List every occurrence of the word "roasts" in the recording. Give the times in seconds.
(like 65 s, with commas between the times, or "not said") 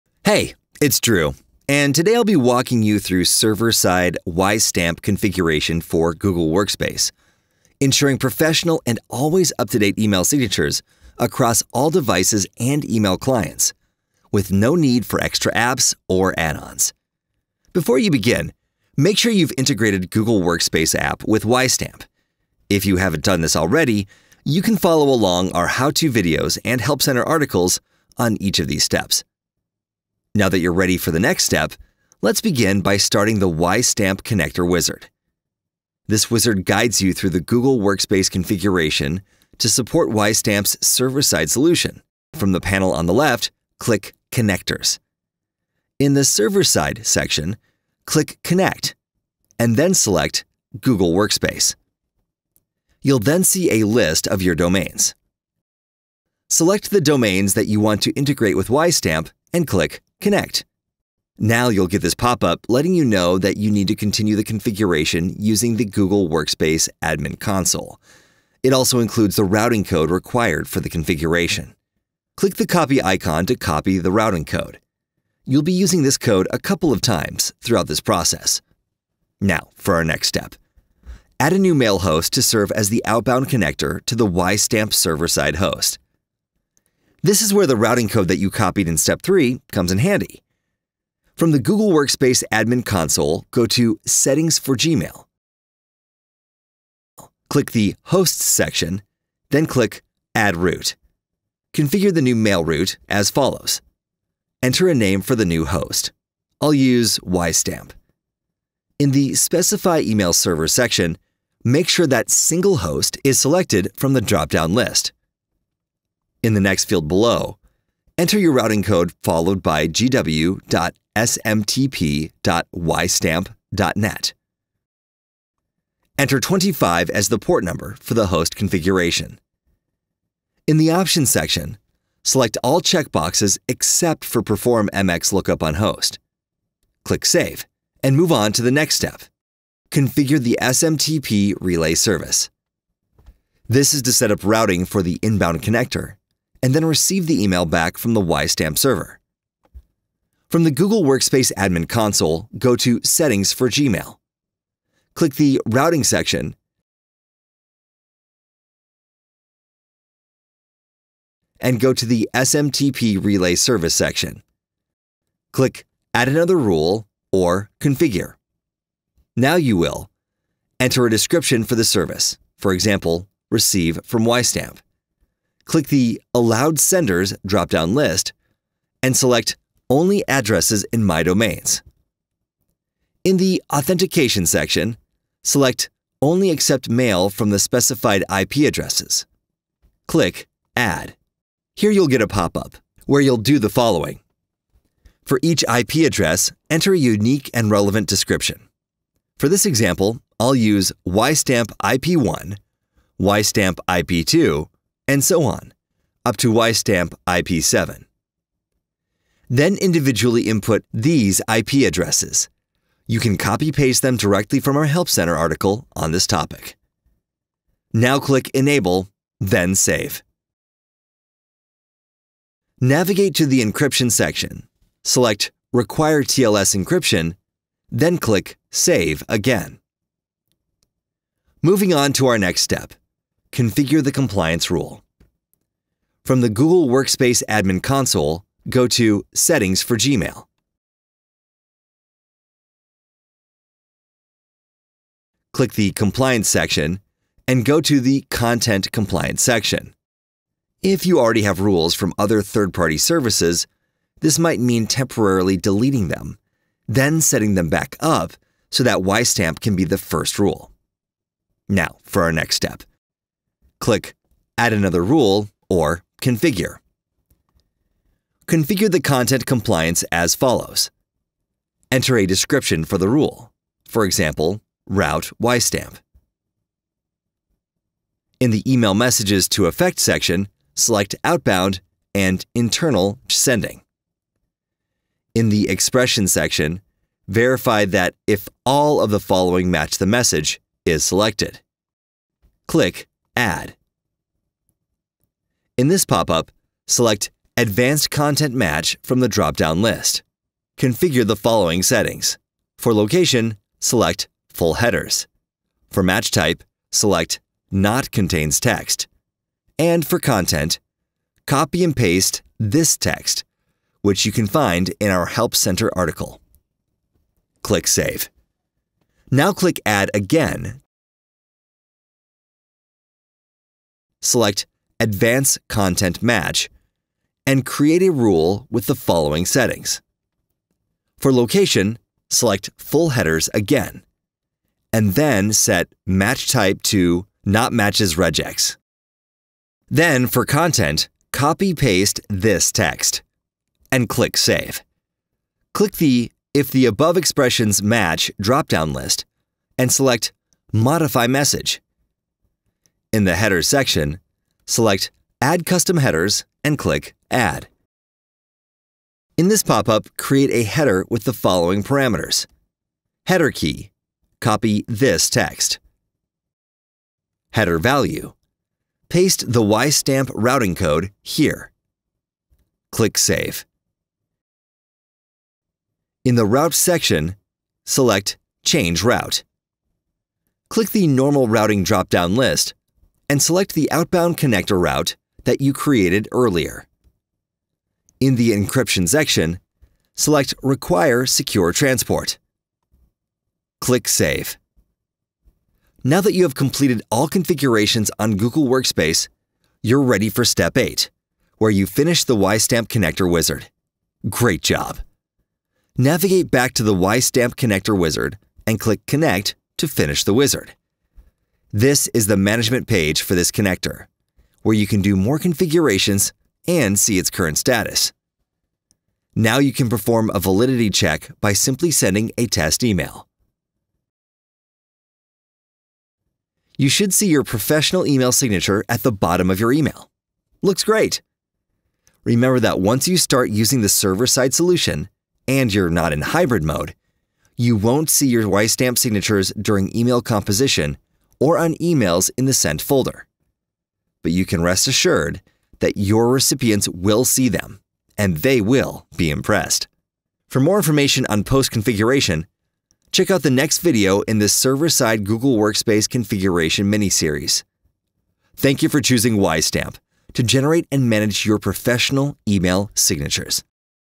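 not said.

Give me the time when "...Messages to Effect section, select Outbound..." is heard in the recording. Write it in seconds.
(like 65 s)
278 s.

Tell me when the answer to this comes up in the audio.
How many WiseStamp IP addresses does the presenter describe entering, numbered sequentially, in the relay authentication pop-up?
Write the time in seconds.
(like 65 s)
207 s.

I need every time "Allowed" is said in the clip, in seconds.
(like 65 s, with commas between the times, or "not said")
176 s.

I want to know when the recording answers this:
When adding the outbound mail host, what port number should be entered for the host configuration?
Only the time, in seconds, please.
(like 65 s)
126 s.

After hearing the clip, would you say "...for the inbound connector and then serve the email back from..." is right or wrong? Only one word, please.
wrong.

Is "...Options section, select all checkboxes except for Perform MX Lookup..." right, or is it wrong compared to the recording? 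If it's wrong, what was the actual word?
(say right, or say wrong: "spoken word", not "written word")
right.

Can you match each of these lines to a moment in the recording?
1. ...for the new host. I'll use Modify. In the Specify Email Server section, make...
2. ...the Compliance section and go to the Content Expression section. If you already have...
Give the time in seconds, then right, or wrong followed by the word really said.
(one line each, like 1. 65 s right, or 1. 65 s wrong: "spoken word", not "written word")
1. 105 s wrong: "WiseStamp", not "Modify"
2. 245 s wrong: "Compliance", not "Expression".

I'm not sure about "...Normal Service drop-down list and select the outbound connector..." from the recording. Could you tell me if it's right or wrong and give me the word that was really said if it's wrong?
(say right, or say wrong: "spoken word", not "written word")
wrong: "Routing", not "Service".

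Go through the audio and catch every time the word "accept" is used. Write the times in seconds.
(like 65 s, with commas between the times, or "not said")
186 s.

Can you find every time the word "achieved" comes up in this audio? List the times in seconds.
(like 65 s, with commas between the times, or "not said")
not said.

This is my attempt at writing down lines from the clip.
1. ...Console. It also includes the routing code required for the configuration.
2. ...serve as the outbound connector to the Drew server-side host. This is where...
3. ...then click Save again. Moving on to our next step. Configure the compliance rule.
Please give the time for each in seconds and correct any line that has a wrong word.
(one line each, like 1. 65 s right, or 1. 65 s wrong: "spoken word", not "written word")
1. 67 s right
2. 82 s wrong: "WiseStamp", not "Drew"
3. 227 s right.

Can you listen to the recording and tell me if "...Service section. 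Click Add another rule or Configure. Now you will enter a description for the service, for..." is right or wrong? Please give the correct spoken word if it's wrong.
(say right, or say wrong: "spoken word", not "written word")
right.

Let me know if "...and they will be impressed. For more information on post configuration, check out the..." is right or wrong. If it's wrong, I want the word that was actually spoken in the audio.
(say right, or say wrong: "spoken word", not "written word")
right.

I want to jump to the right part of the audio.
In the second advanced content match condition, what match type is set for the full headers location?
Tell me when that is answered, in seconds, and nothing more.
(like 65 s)
337 s.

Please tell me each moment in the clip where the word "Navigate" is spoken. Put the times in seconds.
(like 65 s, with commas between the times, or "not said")
222 s, 405 s.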